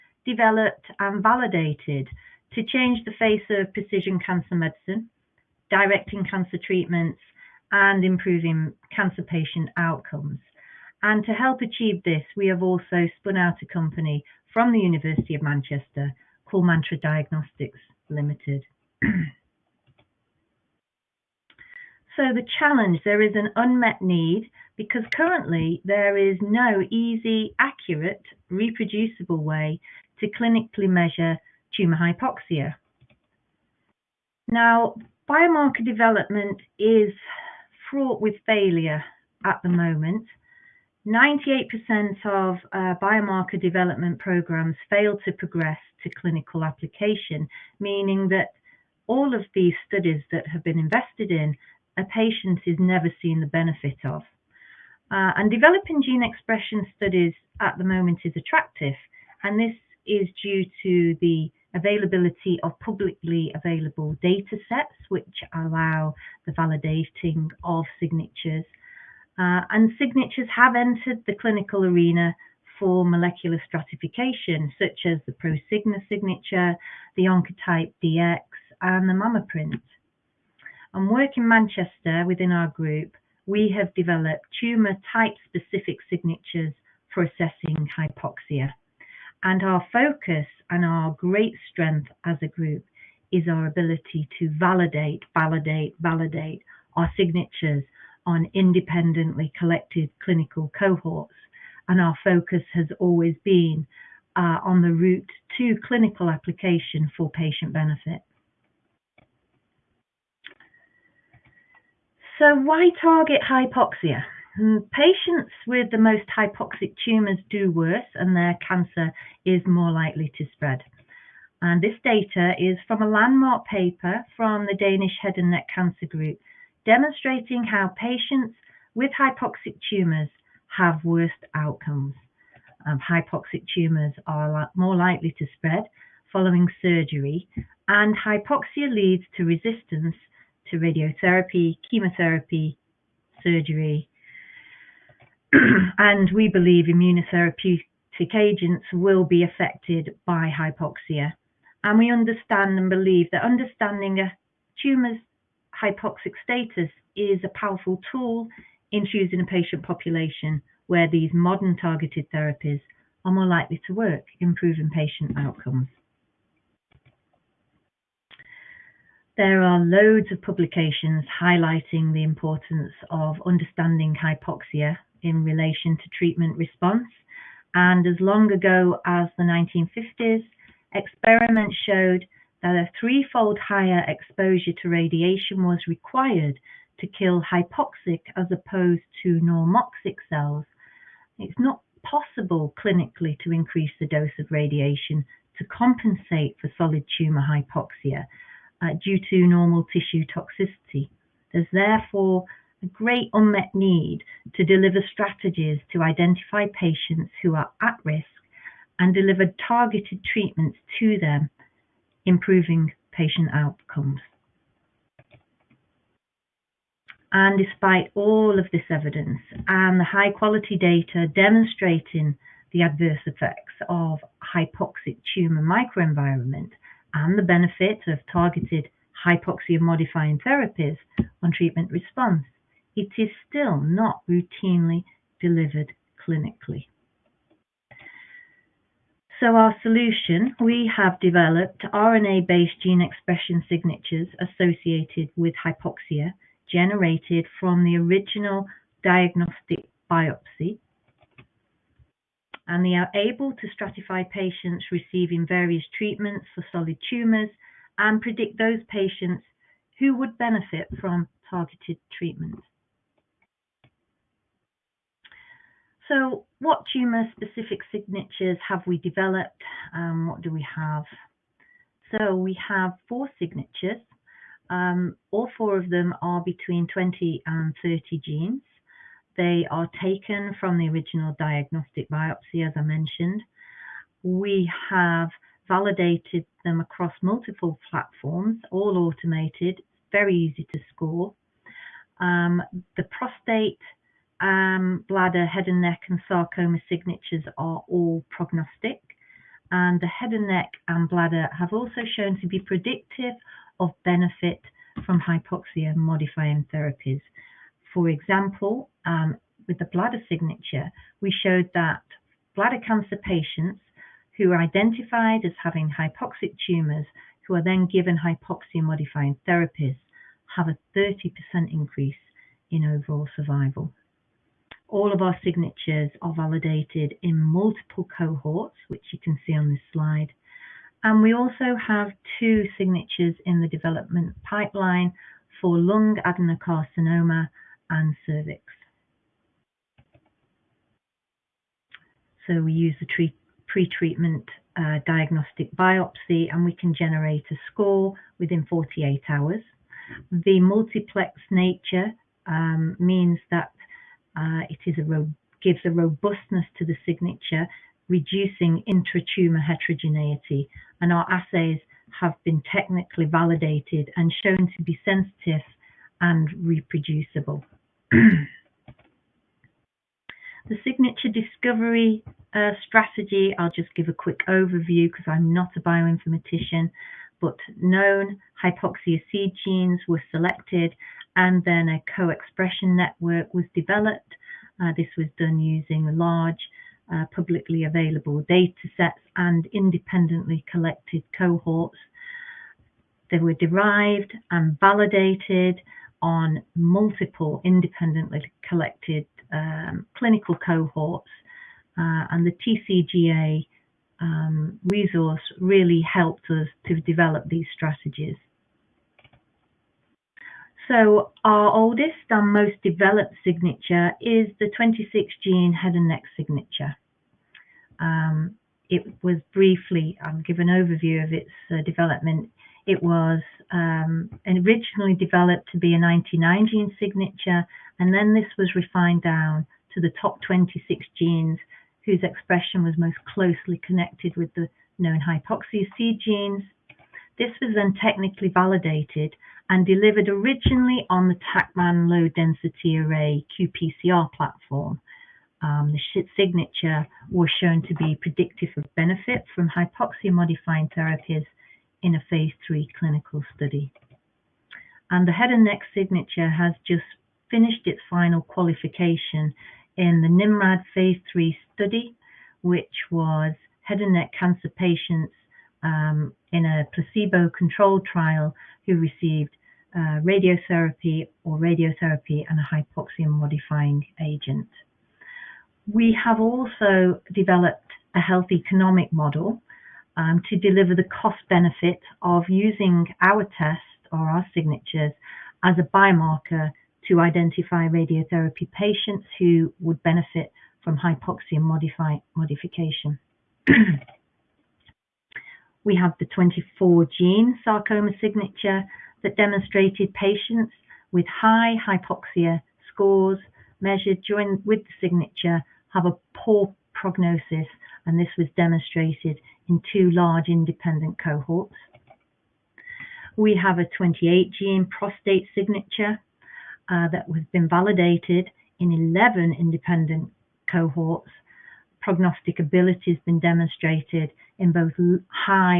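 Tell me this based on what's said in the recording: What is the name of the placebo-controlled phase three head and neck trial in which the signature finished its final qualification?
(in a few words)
NIMRAD.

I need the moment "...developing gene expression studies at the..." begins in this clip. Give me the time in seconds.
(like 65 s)
55 s.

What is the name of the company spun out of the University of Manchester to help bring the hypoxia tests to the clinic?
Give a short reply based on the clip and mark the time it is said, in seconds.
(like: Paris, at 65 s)
Mantra Diagnostics Limited, at 16 s.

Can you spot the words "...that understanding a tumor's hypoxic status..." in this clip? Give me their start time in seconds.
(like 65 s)
153 s.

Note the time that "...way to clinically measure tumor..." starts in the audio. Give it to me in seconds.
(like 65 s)
29 s.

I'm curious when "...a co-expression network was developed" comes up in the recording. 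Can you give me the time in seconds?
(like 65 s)
381 s.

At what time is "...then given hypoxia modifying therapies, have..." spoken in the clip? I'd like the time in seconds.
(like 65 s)
317 s.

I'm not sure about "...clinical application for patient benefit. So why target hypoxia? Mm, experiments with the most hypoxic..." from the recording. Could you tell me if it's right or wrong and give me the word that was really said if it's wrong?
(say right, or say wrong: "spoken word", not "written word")
wrong: "patients", not "experiments".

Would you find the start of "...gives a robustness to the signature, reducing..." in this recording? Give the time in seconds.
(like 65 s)
355 s.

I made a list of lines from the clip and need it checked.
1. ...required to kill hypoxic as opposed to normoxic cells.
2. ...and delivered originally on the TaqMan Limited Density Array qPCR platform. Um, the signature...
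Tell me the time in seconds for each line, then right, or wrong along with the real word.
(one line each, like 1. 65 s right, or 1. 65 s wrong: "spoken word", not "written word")
1. 185 s right
2. 439 s wrong: "Low", not "Limited".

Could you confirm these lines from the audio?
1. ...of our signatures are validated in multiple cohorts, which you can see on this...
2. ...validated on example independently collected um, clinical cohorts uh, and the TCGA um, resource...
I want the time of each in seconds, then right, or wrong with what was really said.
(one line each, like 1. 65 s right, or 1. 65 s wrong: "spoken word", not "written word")
1. 325 s right
2. 394 s wrong: "multiple", not "example".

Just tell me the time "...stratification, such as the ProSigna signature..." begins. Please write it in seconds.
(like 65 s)
73 s.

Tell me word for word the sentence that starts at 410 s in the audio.
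So our oldest and most developed signature is the 26 gene head and neck signature.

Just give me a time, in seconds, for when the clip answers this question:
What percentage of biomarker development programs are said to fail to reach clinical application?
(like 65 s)
41 s.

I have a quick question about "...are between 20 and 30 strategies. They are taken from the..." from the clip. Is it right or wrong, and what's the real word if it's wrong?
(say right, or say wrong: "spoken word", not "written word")
wrong: "genes", not "strategies".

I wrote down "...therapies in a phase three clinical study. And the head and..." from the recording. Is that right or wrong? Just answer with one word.
right.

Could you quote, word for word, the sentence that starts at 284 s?
We have validated them across multiple platforms, all automated, very easy to score.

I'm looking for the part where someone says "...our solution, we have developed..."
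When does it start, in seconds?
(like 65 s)
239 s.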